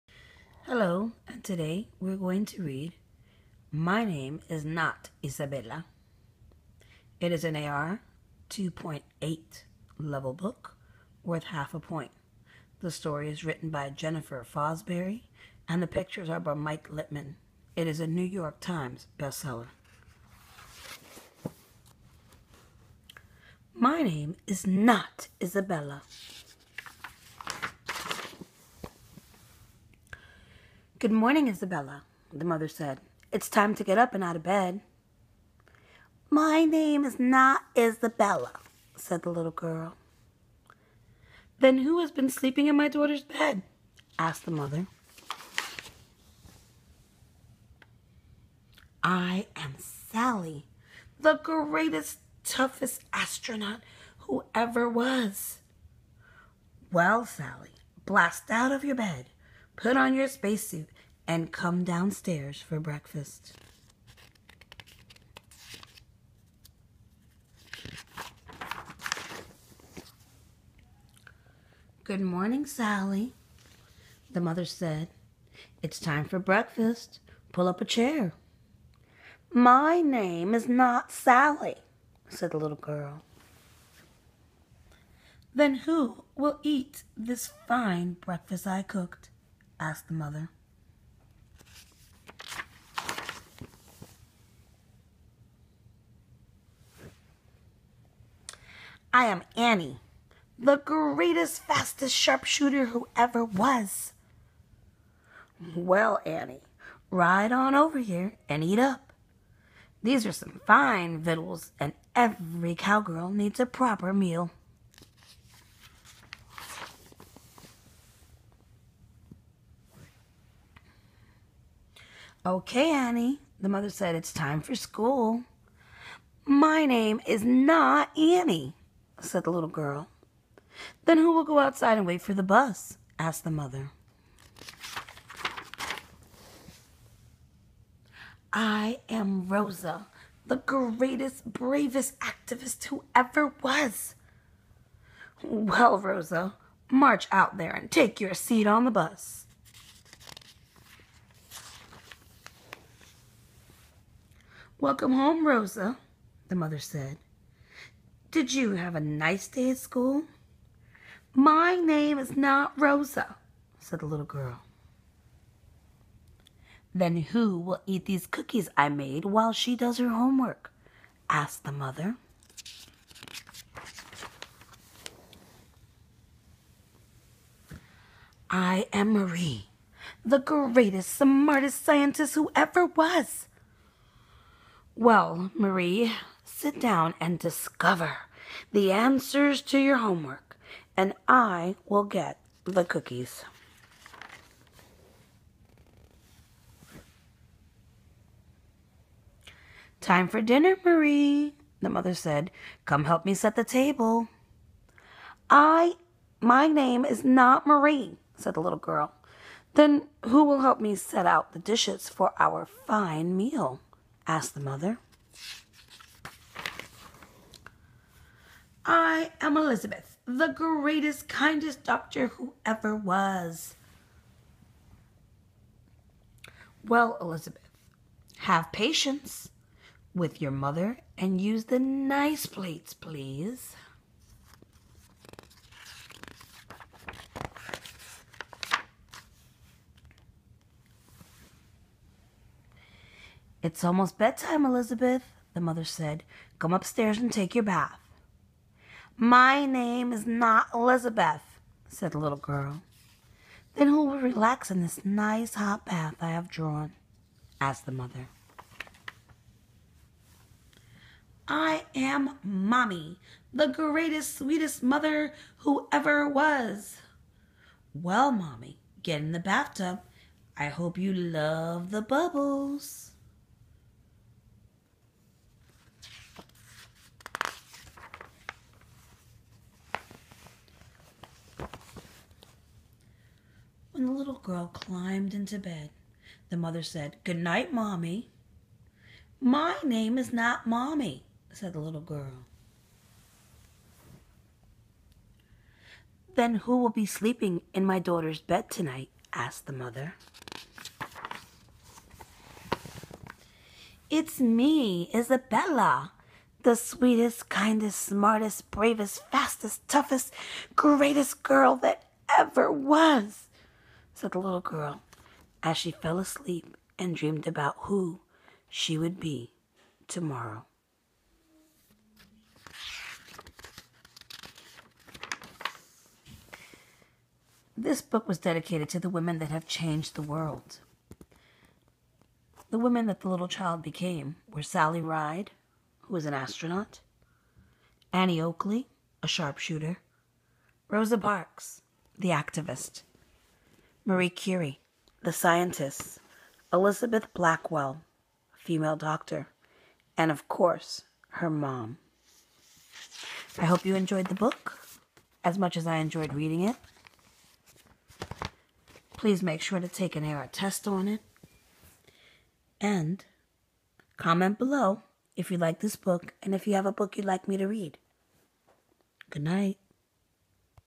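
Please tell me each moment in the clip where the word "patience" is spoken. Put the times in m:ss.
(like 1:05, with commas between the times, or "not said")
3:48.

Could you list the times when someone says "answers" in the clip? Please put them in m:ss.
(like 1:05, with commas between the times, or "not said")
3:08.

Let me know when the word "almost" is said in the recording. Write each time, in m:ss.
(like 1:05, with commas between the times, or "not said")
4:03.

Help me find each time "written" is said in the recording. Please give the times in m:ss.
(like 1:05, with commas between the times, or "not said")
0:13.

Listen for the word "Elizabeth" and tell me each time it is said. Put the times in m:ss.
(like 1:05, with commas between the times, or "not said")
3:39, 3:47, 4:04, 4:10, 5:46.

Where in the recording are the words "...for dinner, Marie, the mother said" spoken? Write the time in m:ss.
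3:20.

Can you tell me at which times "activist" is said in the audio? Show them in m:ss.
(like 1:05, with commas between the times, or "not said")
2:22, 5:42.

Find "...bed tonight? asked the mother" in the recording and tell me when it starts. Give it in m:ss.
4:58.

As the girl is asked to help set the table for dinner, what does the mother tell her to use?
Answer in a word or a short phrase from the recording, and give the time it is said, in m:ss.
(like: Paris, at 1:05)
the nice plates, at 3:51.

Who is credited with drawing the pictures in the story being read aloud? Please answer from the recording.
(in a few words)
Mike Litwin.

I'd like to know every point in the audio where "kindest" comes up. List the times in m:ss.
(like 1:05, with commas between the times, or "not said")
3:41, 5:07.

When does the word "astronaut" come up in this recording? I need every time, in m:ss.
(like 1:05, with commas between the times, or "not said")
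0:53, 5:36.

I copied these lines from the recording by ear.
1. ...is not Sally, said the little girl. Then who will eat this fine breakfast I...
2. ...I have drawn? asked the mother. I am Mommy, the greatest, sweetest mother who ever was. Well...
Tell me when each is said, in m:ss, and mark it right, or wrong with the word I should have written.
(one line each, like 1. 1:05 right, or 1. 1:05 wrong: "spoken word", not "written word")
1. 1:20 right
2. 4:16 right.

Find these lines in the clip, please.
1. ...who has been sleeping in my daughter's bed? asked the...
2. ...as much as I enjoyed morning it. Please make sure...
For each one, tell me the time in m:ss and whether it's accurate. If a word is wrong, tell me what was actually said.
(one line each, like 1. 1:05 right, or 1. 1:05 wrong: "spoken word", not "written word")
1. 0:41 right
2. 5:55 wrong: "reading", not "morning".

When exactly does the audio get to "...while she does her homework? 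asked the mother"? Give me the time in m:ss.
2:49.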